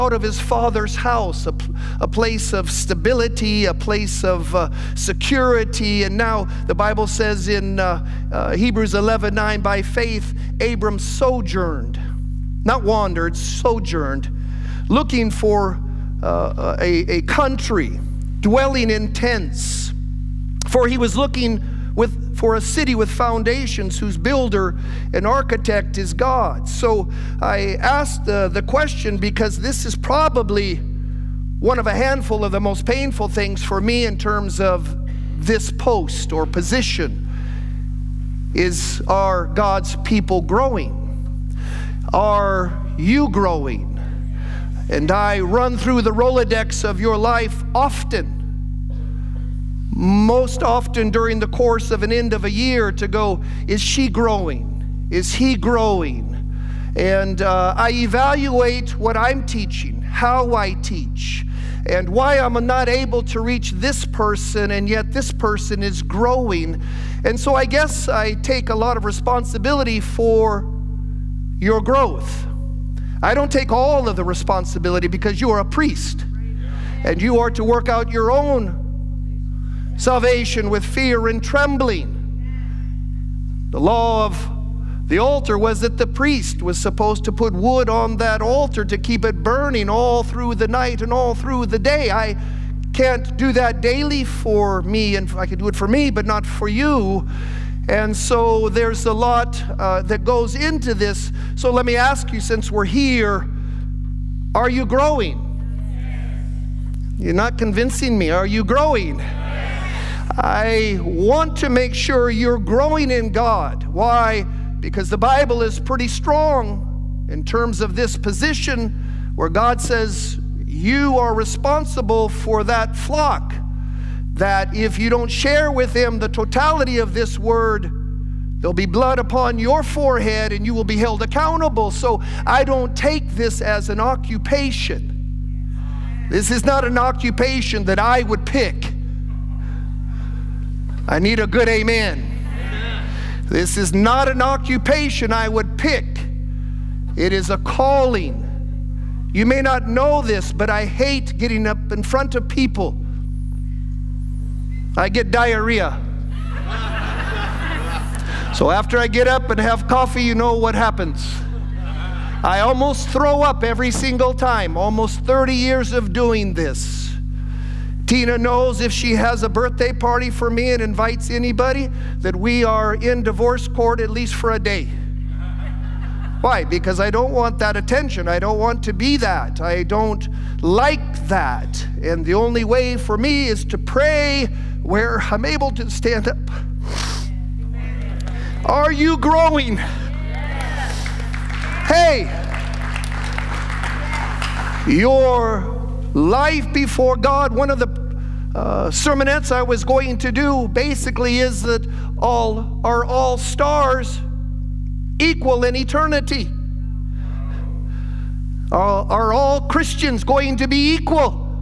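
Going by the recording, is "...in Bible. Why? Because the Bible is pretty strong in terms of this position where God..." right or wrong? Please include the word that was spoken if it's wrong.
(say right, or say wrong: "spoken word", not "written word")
wrong: "God", not "Bible".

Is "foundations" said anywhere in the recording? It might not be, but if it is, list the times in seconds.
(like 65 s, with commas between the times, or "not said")
23 s.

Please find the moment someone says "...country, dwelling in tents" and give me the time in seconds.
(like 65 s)
17 s.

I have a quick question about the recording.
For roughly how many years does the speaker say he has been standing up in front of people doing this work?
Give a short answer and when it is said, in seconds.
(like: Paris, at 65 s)
almost 30 years, at 165 s.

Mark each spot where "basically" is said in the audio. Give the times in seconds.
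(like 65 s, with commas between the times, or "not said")
200 s.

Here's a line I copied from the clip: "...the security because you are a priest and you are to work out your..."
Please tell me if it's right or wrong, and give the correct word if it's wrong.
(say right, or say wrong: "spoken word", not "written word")
wrong: "responsibility", not "security".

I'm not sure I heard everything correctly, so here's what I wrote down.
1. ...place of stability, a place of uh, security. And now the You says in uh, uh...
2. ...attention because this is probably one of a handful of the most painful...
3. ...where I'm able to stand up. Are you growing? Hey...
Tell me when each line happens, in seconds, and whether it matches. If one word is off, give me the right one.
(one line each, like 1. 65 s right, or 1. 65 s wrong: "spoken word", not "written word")
1. 2 s wrong: "Bible", not "You"
2. 28 s wrong: "question", not "attention"
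3. 184 s right.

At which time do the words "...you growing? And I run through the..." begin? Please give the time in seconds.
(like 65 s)
42 s.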